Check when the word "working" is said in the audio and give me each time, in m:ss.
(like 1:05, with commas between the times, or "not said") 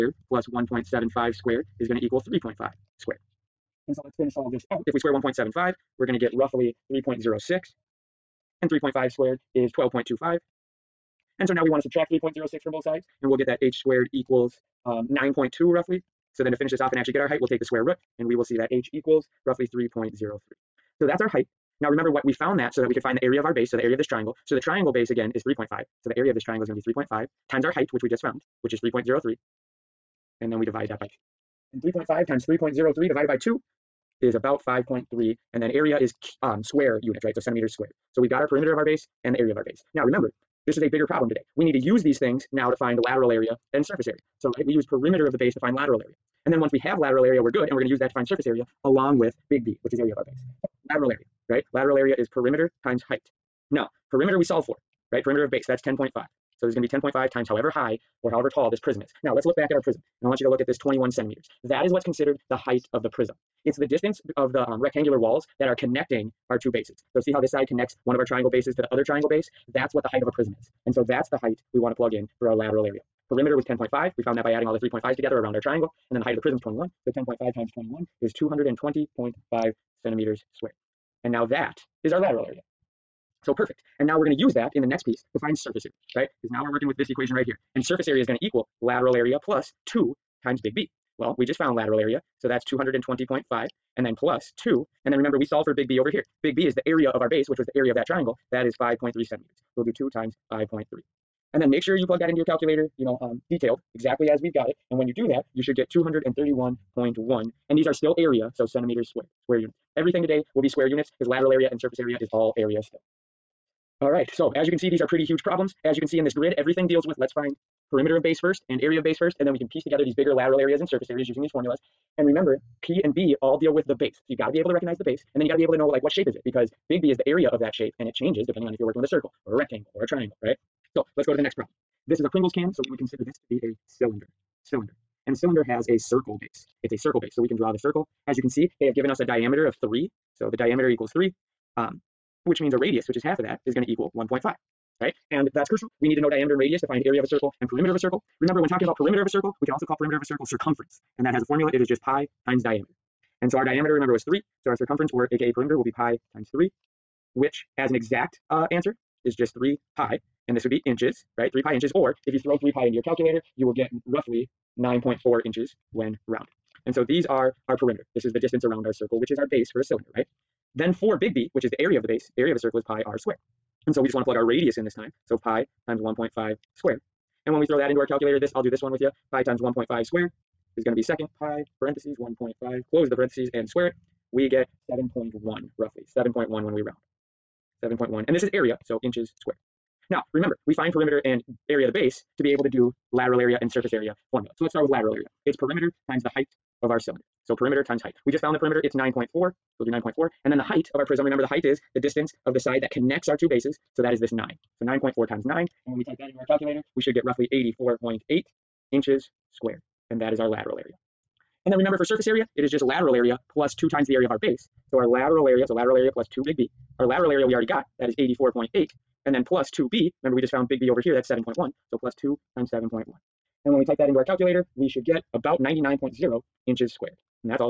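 1:26, 2:08.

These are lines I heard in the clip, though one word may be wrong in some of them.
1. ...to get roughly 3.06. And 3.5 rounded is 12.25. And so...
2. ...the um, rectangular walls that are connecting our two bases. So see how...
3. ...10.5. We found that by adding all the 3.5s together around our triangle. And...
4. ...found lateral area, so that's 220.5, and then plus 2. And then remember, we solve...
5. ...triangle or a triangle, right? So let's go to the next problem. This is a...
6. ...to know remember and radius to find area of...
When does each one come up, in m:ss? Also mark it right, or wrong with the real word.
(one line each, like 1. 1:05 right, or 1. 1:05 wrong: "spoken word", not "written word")
1. 0:06 wrong: "squared", not "rounded"
2. 1:04 right
3. 1:13 right
4. 1:31 right
5. 2:09 wrong: "rectangle", not "triangle"
6. 2:26 wrong: "diameter", not "remember".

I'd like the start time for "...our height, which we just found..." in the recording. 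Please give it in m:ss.
0:27.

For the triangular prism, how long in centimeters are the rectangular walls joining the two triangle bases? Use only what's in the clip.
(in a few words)
21.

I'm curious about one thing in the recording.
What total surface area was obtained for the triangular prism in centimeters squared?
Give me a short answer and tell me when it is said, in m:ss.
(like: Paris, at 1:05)
231.1, at 1:45.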